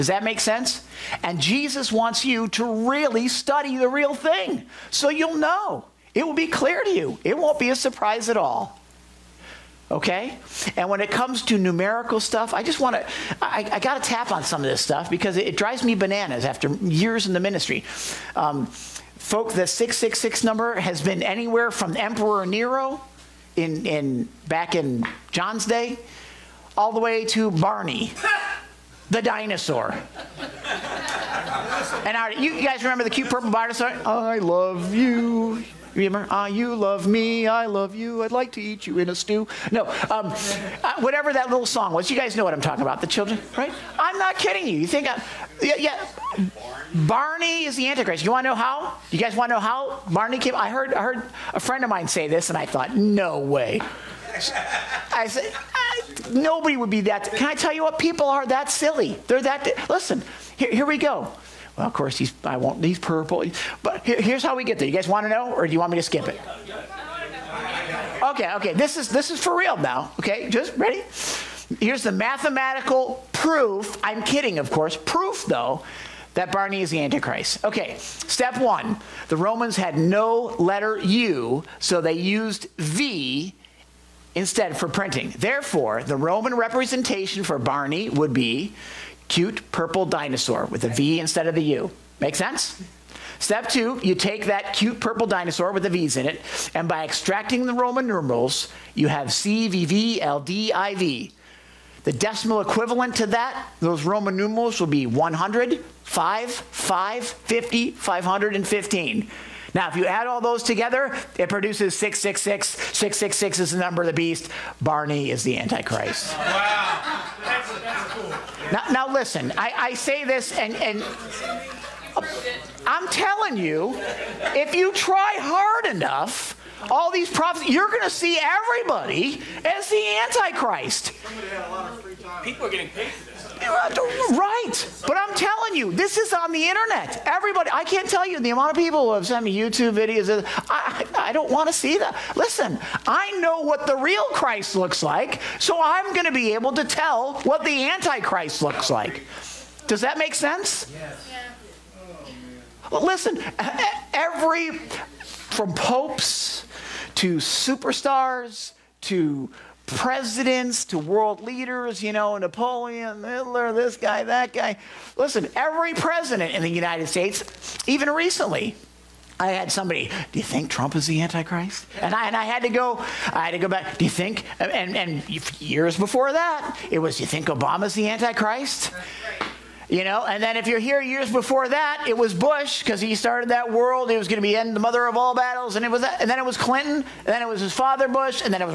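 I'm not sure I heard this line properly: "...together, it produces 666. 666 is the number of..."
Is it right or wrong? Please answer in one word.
right.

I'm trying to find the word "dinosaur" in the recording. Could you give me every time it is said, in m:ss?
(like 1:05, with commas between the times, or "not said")
0:29, 0:33, 1:30, 1:35.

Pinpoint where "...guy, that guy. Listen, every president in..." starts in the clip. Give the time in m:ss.
2:43.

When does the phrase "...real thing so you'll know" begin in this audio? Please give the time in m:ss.
0:03.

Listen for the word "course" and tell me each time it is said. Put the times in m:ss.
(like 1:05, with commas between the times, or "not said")
1:01, 1:14.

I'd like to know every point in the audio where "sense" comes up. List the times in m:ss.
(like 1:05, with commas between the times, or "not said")
0:00, 1:32, 2:30.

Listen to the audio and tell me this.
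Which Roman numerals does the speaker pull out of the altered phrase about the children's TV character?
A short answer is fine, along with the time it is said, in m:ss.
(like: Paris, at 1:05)
CVVLDIV, at 1:39.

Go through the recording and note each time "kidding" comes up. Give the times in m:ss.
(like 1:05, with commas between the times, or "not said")
0:44, 1:14.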